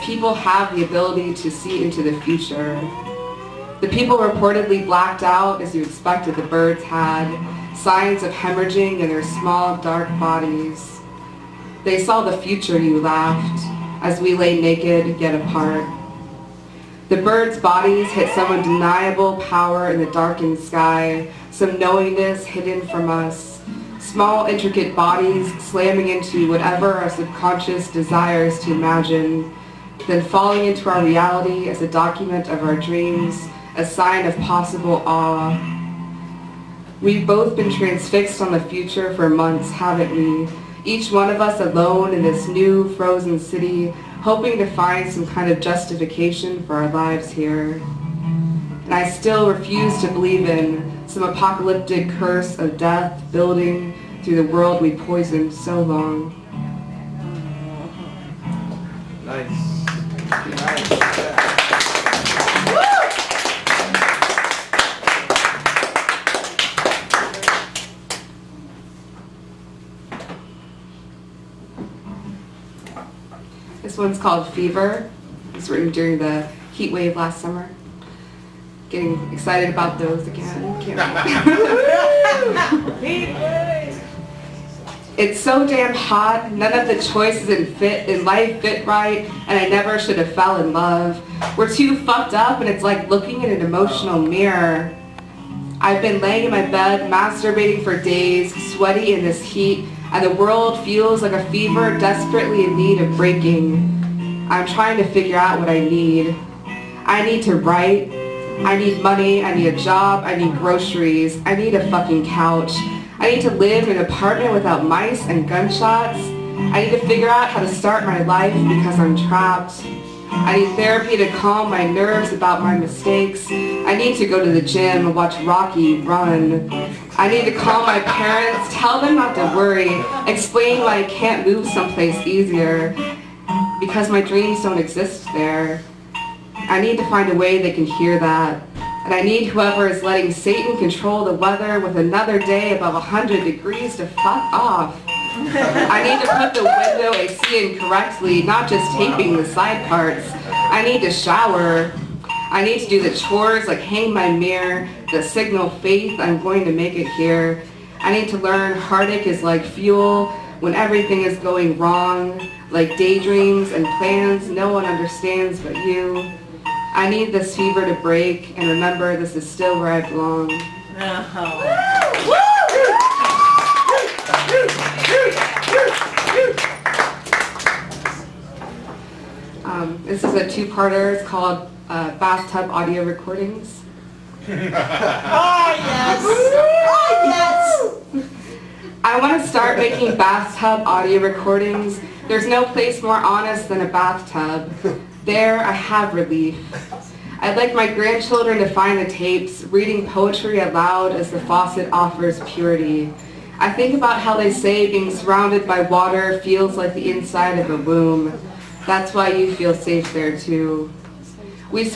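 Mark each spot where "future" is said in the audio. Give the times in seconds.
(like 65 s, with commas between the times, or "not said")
2 s, 12 s, 38 s.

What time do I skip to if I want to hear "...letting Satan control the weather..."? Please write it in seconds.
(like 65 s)
140 s.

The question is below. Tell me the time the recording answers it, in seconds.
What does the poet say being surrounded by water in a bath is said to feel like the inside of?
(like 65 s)
207 s.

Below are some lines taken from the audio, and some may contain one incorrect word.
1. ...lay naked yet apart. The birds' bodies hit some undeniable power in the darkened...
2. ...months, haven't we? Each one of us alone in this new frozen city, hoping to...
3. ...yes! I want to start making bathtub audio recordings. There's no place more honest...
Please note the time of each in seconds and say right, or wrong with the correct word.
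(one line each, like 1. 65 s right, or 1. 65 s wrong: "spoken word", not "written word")
1. 14 s right
2. 39 s right
3. 188 s right.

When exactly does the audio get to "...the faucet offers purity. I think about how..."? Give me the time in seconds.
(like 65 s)
201 s.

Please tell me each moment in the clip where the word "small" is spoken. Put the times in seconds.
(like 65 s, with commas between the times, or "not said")
9 s, 23 s.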